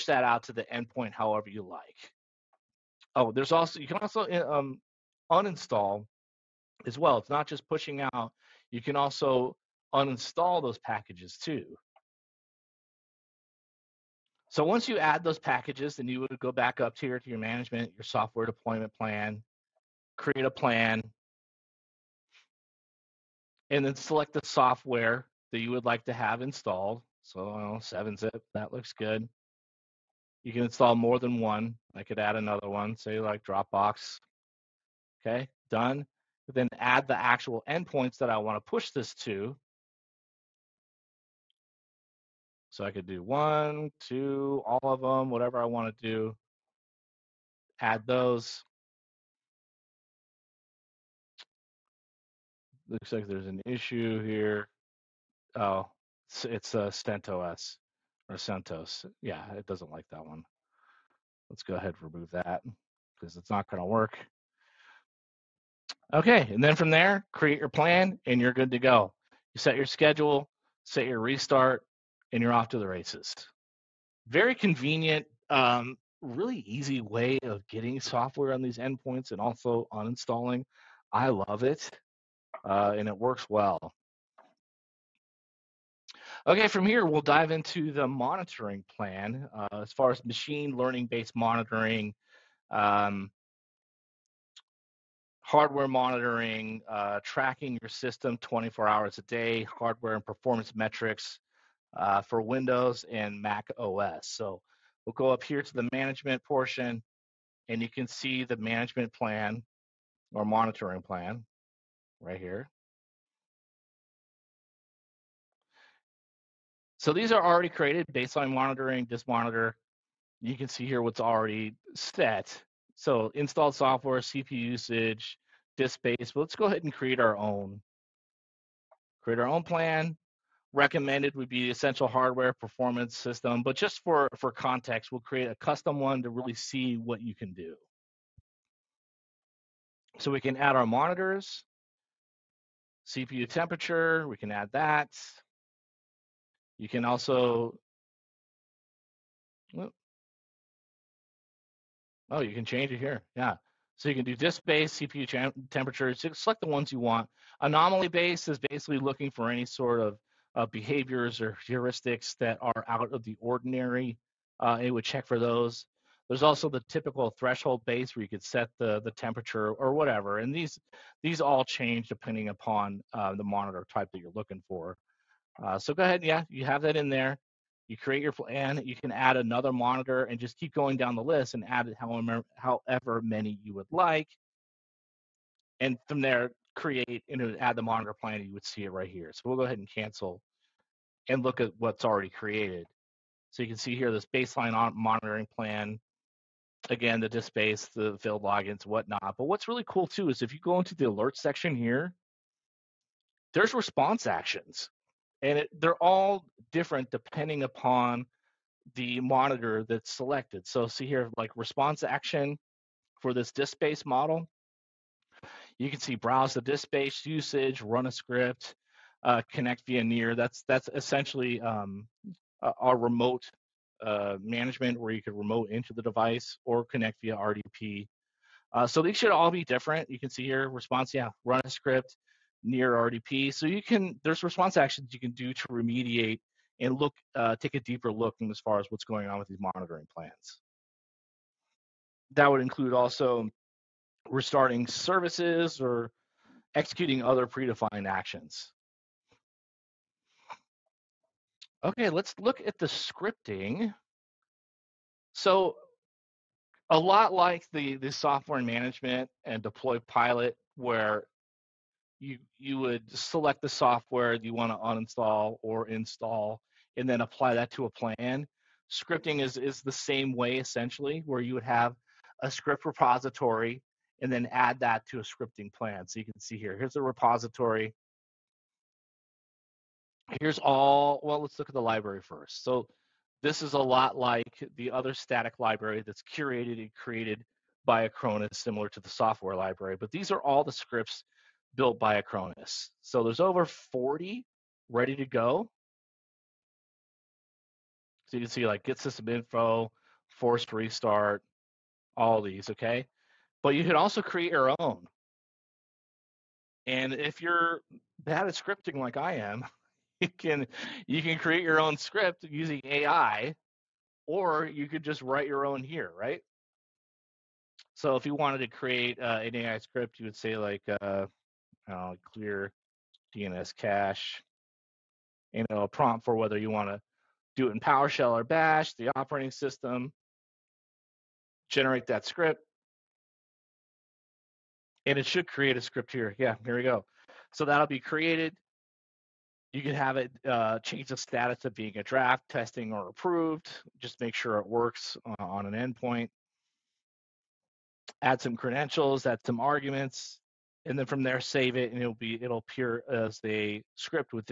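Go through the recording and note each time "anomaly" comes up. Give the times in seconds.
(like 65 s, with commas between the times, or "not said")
157 s.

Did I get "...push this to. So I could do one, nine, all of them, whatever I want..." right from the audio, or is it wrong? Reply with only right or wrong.
wrong.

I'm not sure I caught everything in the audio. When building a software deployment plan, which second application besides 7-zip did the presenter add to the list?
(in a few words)
Dropbox.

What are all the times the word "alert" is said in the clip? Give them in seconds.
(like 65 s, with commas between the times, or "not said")
201 s.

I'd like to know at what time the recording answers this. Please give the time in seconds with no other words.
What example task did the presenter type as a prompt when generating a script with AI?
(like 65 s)
322 s.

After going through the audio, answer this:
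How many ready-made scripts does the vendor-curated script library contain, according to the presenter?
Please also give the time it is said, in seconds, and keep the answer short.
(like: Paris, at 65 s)
over 40, at 293 s.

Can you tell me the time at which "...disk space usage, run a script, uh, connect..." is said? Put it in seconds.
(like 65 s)
216 s.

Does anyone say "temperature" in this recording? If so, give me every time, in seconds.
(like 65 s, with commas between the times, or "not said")
143 s, 155 s, 169 s.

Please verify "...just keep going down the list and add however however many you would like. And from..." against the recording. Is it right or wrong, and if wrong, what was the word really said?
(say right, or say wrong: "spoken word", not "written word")
right.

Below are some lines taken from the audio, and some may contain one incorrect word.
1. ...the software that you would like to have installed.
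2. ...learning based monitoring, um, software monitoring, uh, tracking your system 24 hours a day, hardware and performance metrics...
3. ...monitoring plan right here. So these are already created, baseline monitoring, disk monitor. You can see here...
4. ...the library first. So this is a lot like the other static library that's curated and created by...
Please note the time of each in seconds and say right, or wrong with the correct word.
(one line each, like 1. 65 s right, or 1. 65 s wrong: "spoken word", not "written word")
1. 24 s right
2. 90 s wrong: "hardware", not "software"
3. 110 s right
4. 281 s right.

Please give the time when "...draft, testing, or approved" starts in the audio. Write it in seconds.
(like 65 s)
342 s.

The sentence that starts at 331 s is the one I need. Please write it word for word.
Generate that script, and it should create a script here.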